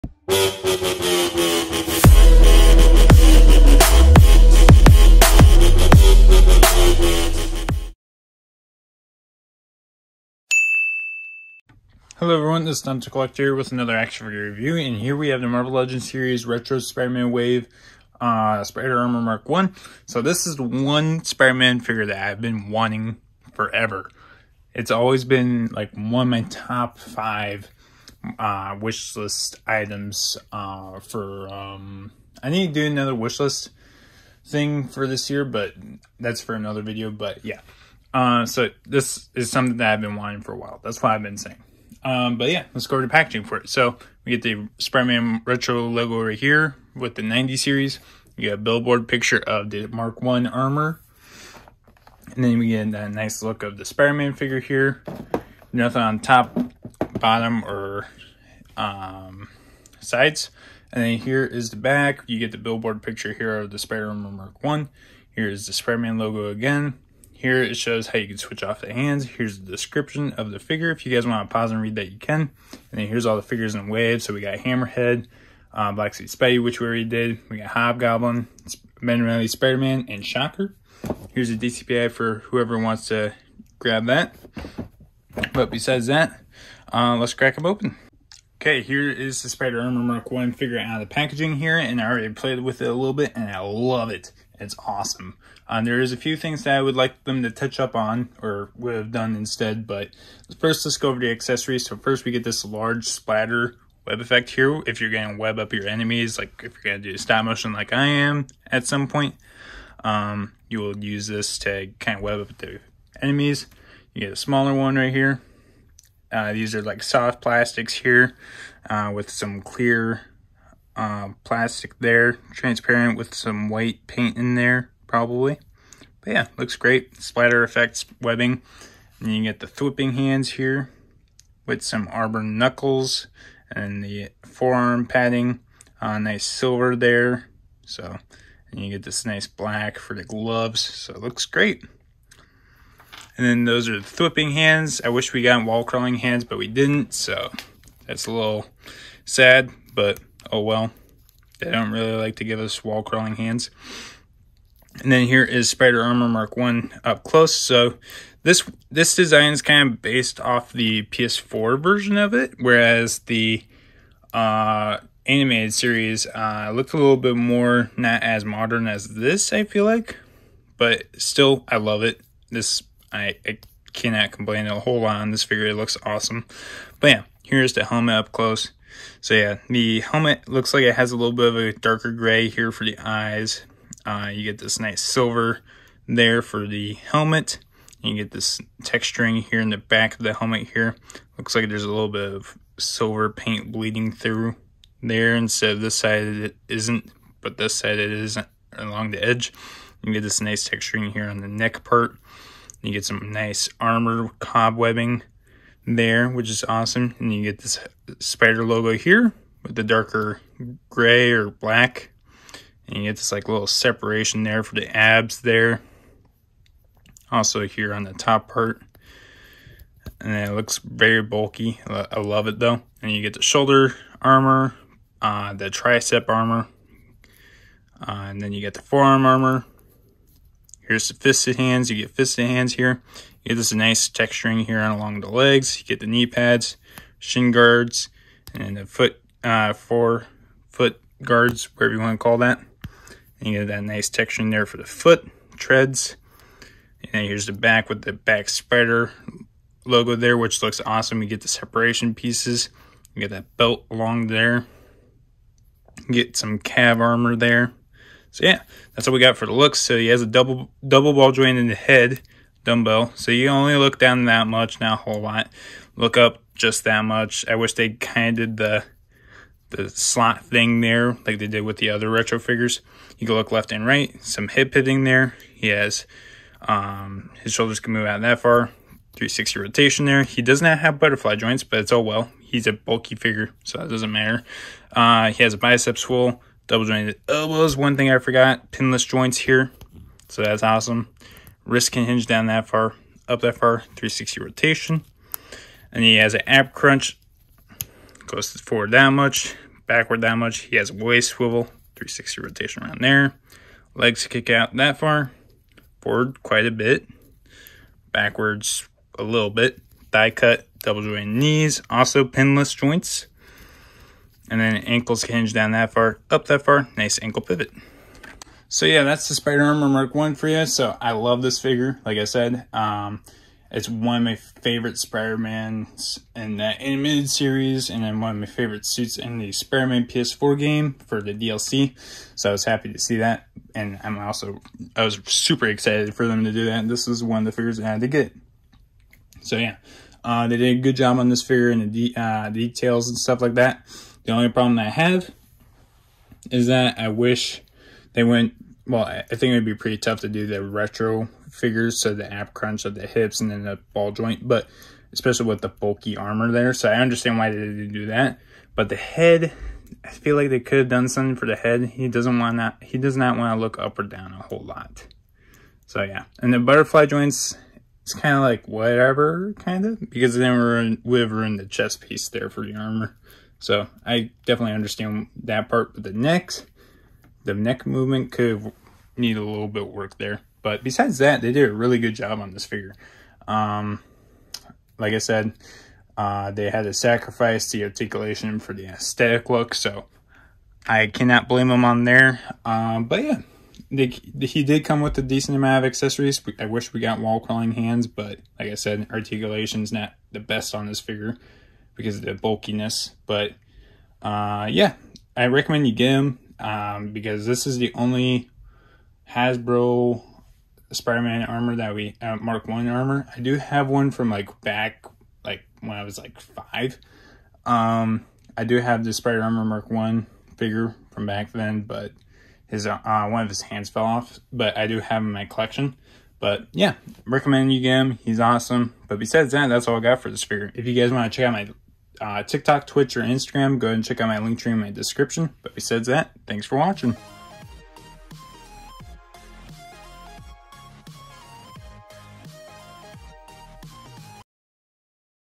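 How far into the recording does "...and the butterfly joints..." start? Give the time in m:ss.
6:06.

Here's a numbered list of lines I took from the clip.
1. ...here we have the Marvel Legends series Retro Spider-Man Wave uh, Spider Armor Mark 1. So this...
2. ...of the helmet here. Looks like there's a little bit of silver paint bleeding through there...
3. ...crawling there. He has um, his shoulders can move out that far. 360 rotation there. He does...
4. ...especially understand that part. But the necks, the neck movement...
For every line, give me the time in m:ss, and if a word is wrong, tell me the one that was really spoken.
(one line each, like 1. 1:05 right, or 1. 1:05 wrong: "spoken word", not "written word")
1. 0:14 right
2. 3:10 right
3. 4:34 wrong: "hitting", not "crawling"
4. 6:14 wrong: "definitely", not "especially".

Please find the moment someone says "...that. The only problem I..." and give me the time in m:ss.
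5:43.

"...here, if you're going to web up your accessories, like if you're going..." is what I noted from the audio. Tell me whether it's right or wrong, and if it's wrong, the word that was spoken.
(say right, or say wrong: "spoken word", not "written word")
wrong: "enemies", not "accessories".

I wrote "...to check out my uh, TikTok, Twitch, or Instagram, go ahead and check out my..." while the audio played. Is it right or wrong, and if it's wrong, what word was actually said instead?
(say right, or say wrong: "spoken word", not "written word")
right.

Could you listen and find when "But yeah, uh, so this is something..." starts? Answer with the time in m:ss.
0:37.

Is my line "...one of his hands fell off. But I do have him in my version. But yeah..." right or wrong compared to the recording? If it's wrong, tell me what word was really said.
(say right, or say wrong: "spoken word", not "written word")
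wrong: "collection", not "version".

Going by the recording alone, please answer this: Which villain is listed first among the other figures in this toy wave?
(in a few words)
Hammerhead.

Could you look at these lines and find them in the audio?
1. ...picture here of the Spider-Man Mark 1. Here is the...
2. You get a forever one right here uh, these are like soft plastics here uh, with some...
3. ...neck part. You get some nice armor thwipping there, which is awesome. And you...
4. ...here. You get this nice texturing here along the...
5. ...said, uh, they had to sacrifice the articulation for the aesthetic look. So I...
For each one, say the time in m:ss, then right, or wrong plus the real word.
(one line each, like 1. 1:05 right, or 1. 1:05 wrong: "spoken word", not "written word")
1. 1:03 right
2. 1:54 wrong: "smaller", not "forever"
3. 3:21 wrong: "cobwebbing", not "thwipping"
4. 3:52 right
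5. 6:25 right.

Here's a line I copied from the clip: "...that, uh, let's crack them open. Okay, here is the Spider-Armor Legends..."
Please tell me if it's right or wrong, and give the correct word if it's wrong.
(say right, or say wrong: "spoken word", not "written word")
wrong: "Mark", not "Legends".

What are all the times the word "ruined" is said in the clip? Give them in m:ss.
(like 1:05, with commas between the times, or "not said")
6:11.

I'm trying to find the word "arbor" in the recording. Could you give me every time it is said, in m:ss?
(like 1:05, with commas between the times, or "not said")
2:12.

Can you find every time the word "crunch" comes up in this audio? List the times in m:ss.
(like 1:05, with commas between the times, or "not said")
4:56, 5:52.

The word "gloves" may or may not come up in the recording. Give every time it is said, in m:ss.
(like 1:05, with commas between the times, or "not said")
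2:20.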